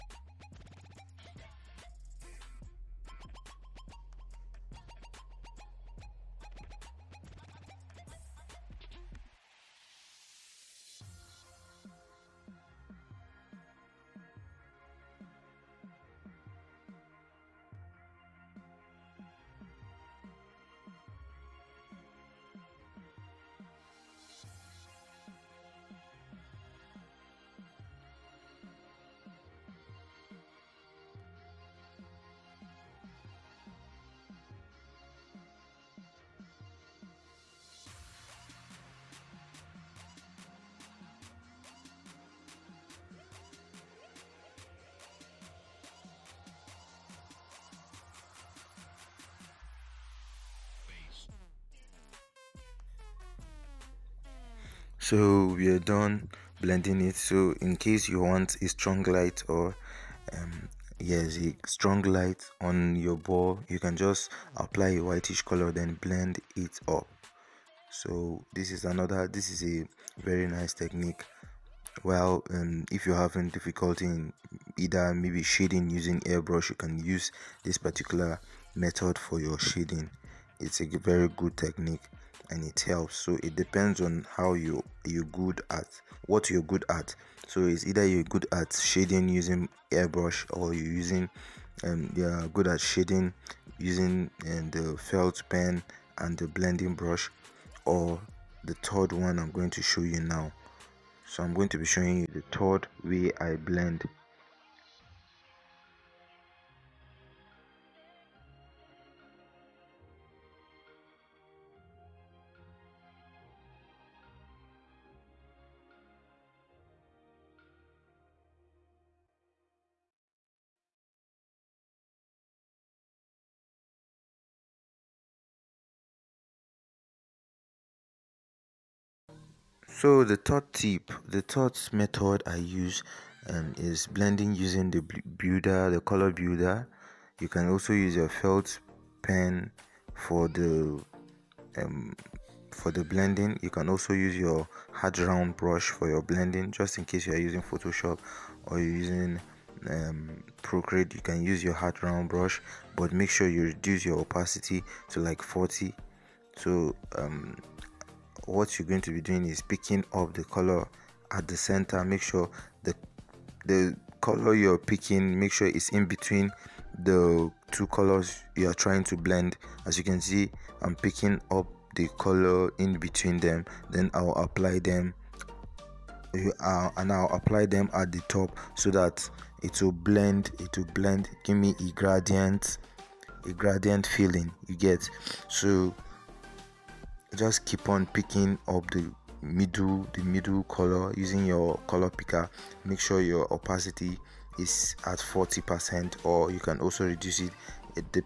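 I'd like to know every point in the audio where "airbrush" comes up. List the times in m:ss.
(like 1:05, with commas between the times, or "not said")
1:16, 1:29.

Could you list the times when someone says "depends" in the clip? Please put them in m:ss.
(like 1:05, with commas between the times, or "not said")
1:23.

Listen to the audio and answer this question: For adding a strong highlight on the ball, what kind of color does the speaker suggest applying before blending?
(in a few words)
whitish color.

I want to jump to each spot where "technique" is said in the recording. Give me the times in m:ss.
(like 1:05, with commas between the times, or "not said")
1:10, 1:21.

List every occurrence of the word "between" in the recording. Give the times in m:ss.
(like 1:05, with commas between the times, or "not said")
2:46, 2:52.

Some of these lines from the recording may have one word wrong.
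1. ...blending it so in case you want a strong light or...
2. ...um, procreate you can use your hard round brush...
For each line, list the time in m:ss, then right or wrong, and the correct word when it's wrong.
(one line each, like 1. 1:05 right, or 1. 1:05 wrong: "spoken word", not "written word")
1. 0:56 right
2. 2:29 right.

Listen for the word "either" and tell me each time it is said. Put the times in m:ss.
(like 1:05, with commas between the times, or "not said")
1:14, 1:27.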